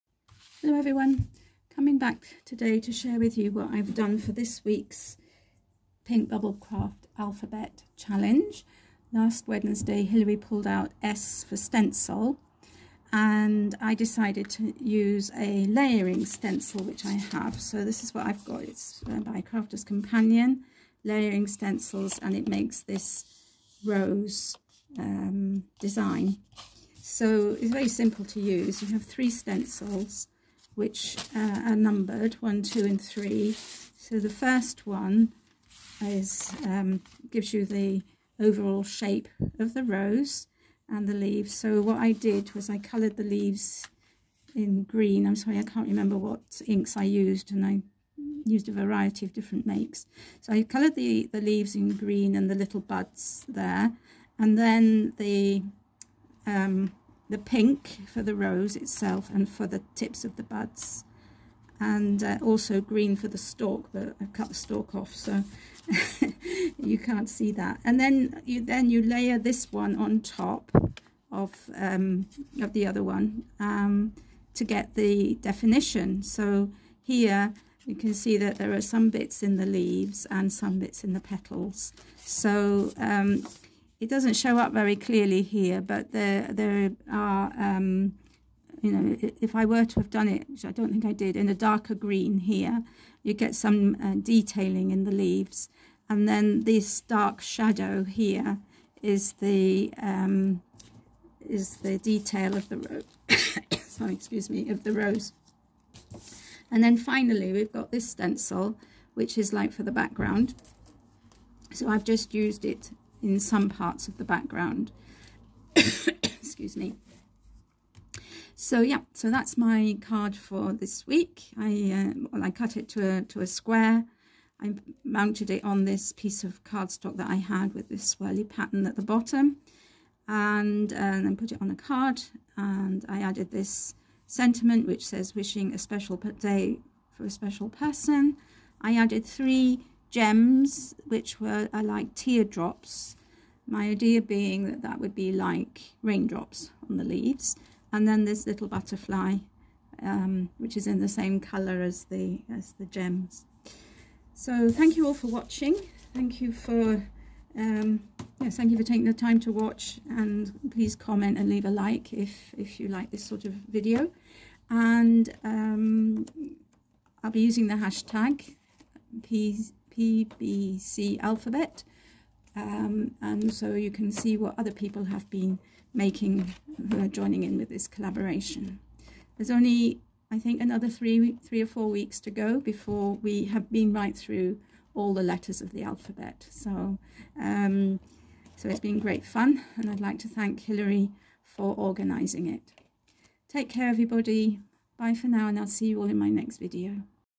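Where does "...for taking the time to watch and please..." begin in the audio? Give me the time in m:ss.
2:38.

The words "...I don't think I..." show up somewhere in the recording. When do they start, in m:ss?
1:30.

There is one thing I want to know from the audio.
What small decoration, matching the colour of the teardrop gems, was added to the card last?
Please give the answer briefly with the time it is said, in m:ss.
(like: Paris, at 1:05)
Butterfly, at 2:28.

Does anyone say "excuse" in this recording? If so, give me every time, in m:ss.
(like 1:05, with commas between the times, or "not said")
1:44, 1:55.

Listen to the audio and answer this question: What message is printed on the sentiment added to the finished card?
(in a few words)
Wishing a special day for a special person.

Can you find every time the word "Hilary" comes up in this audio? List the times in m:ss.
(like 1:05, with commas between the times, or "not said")
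0:10, 3:10.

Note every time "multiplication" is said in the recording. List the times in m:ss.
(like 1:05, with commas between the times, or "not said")
not said.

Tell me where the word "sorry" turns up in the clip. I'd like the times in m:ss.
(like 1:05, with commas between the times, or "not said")
0:45, 1:43.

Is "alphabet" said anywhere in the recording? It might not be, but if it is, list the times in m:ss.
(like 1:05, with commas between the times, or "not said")
0:07, 2:51, 3:05.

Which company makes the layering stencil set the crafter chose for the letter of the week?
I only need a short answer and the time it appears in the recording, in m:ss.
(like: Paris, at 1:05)
Crafter's Companion, at 0:19.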